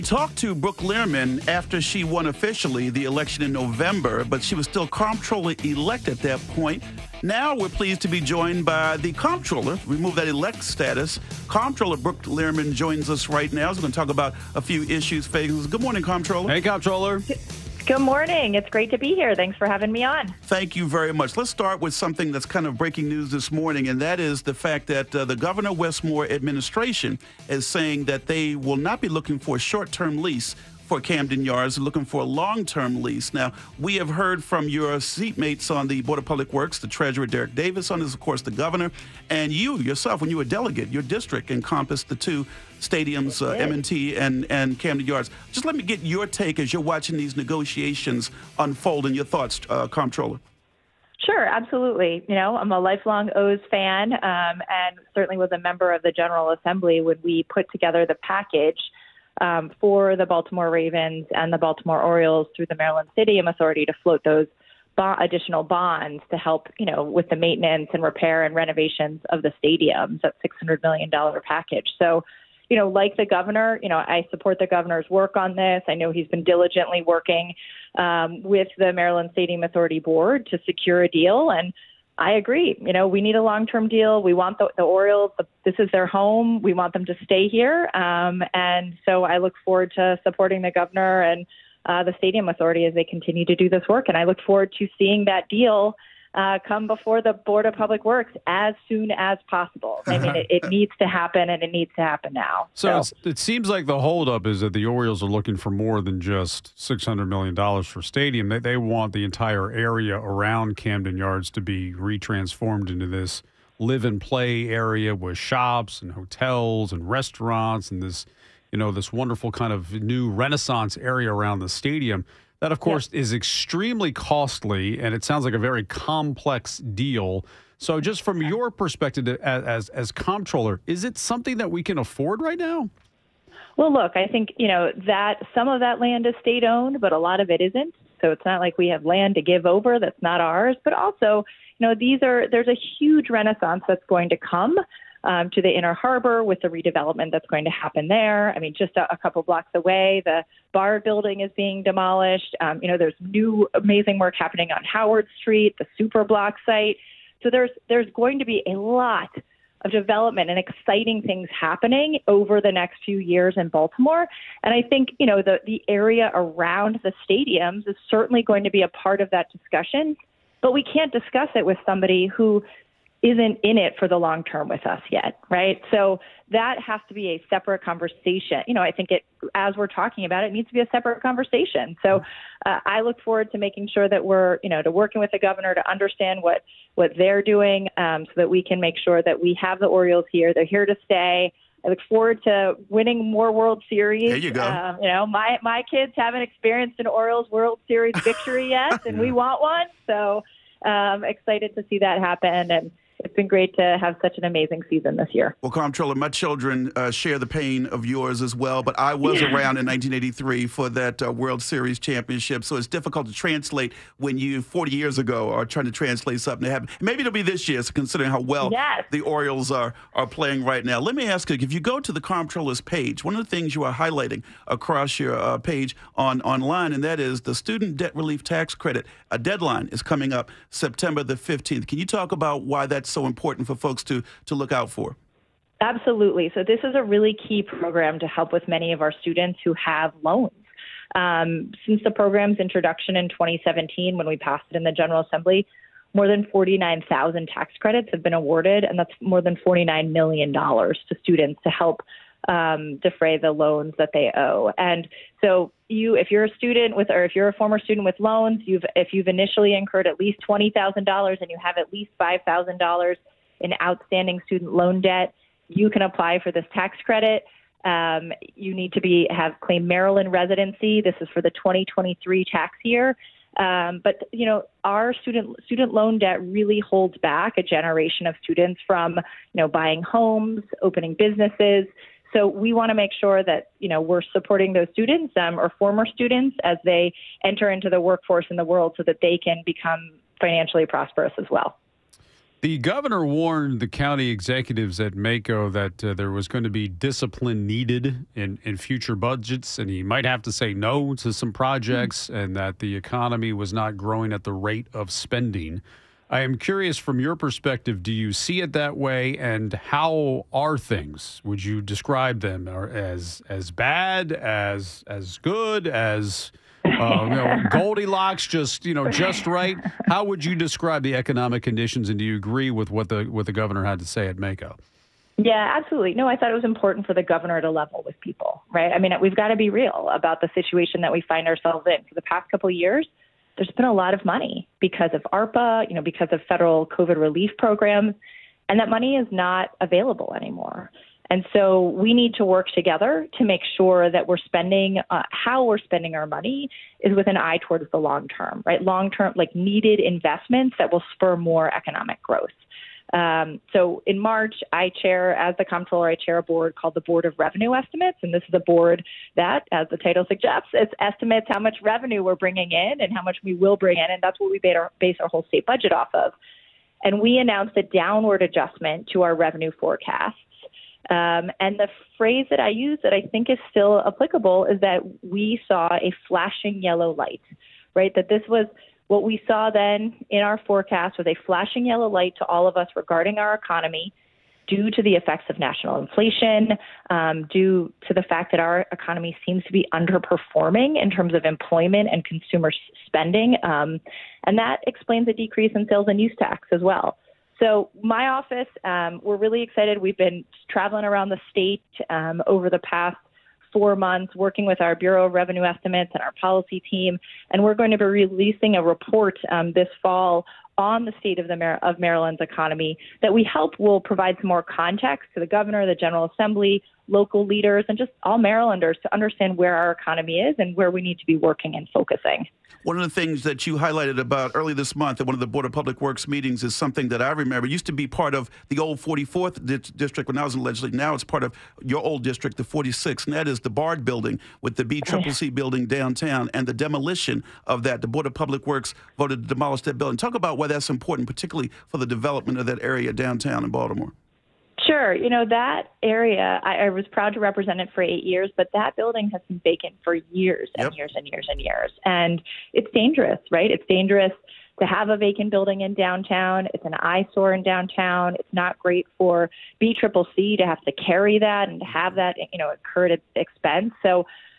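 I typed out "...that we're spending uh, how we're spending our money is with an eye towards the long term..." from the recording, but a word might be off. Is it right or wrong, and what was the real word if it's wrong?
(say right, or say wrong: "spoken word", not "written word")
right.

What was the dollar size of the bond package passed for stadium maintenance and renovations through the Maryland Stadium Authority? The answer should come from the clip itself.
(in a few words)
$600 million.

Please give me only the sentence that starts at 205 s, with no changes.
Well, Comptroller, my children uh, share the pain of yours as well, but I was yeah.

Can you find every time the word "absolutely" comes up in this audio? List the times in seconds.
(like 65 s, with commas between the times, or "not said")
51 s, 235 s, 325 s.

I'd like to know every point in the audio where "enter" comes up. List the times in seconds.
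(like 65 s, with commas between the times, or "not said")
287 s.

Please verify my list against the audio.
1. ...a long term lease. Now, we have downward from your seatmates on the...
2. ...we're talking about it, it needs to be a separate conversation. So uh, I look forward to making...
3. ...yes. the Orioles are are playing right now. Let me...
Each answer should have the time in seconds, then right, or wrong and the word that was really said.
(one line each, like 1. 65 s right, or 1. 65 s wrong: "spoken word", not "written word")
1. 32 s wrong: "heard", not "downward"
2. 179 s right
3. 218 s right.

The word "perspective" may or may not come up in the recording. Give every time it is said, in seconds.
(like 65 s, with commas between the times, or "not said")
128 s, 307 s.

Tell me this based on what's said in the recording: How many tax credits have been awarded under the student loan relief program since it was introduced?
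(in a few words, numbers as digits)
49,000.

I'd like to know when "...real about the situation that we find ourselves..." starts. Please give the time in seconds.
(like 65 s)
329 s.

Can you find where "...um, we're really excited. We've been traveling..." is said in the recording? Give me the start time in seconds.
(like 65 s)
398 s.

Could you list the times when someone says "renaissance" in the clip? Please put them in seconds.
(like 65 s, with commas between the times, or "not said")
120 s, 143 s.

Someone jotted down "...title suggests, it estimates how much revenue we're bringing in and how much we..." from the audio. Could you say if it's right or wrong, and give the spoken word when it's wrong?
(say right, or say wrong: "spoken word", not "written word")
right.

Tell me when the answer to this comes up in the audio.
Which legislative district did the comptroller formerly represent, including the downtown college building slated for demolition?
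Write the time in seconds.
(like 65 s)
432 s.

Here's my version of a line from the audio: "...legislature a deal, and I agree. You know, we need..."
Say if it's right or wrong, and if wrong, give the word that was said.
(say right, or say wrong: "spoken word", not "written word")
wrong: "secure", not "legislature".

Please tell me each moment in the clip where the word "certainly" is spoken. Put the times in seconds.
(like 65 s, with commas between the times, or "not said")
55 s, 168 s.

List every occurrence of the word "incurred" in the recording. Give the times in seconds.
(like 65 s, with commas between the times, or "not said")
259 s, 462 s.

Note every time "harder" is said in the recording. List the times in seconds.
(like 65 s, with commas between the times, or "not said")
not said.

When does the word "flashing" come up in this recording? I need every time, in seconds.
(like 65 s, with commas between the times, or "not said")
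376 s, 381 s.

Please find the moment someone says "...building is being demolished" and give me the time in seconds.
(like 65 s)
151 s.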